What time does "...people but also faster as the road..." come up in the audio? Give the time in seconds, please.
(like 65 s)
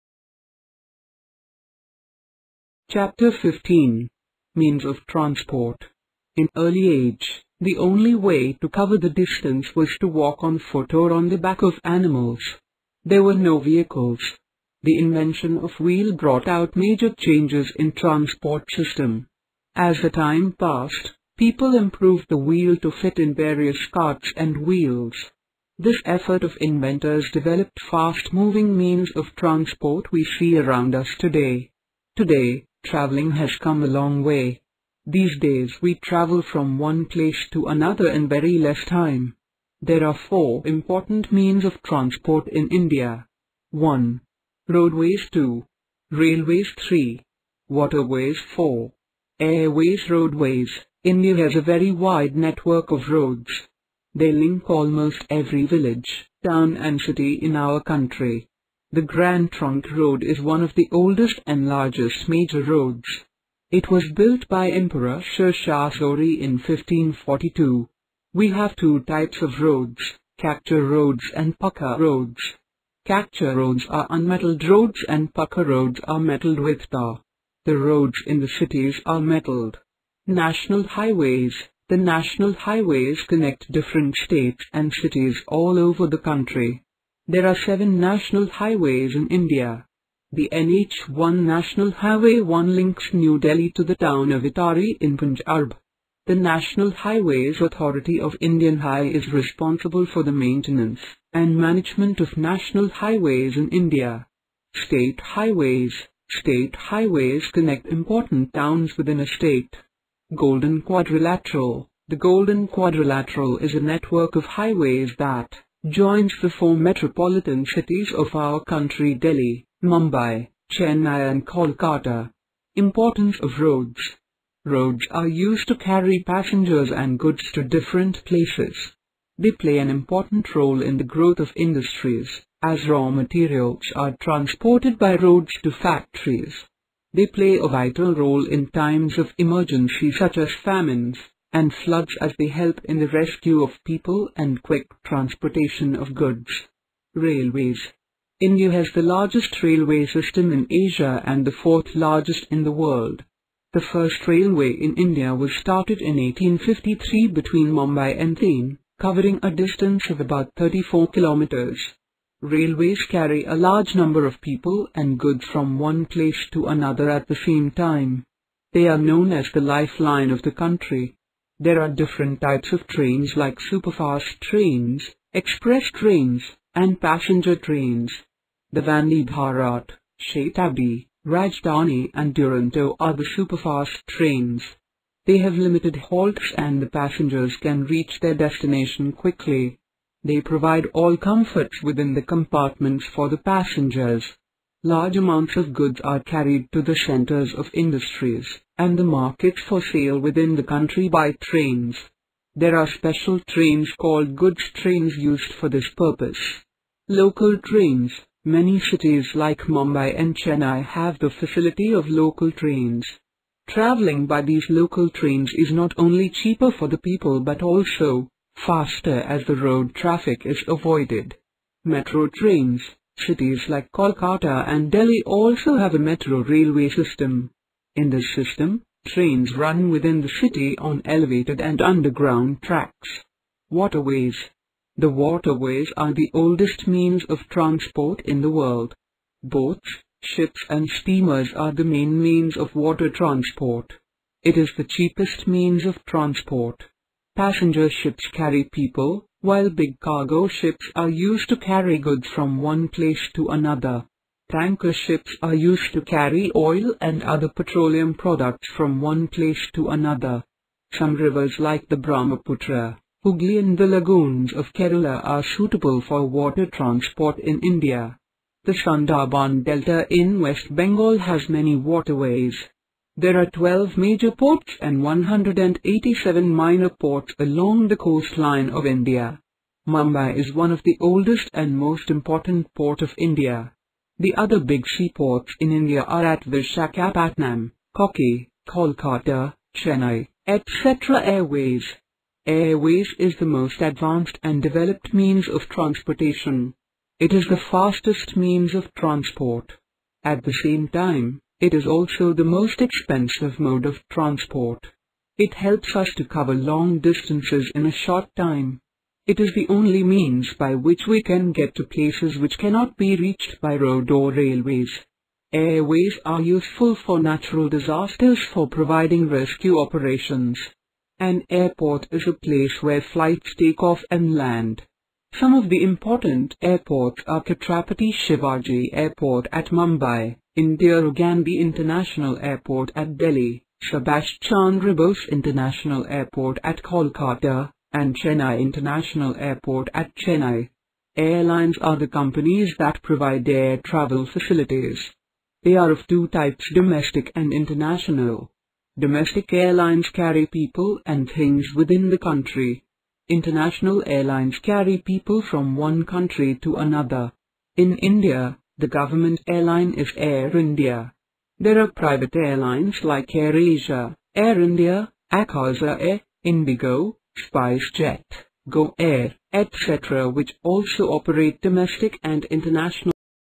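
216 s.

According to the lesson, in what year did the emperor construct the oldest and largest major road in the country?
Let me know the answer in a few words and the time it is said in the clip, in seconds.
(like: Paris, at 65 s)
1542, at 66 s.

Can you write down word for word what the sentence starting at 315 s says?
Airways are useful for natural disasters for providing rescue operations.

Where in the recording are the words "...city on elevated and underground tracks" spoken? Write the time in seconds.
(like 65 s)
230 s.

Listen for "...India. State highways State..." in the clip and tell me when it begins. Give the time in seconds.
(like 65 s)
103 s.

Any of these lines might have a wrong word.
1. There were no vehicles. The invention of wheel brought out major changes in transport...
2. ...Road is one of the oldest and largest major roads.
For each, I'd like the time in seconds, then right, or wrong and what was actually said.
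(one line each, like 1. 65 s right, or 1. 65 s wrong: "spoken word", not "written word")
1. 13 s right
2. 59 s right.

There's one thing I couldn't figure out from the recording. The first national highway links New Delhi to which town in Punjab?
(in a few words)
Attari.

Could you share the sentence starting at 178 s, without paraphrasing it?
The Vande Bharat, Shatabdi, Rajdhani and Duronto are the superfast trains.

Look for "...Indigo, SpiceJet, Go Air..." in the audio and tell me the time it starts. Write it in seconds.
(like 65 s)
366 s.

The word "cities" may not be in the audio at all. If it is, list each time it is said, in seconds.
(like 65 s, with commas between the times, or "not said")
78 s, 84 s, 117 s, 208 s, 223 s.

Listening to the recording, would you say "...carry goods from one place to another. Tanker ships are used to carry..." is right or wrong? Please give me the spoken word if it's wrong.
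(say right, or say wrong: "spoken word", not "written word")
right.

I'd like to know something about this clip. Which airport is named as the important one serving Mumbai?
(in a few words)
Chhatrapati Shivaji Airport.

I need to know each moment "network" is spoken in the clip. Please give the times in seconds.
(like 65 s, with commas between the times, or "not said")
52 s, 113 s.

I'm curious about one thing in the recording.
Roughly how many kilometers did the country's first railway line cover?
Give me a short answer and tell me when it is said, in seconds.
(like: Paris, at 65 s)
34 kilometers, at 160 s.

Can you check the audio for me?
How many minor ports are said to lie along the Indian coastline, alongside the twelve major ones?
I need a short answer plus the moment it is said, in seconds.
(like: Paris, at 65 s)
187, at 275 s.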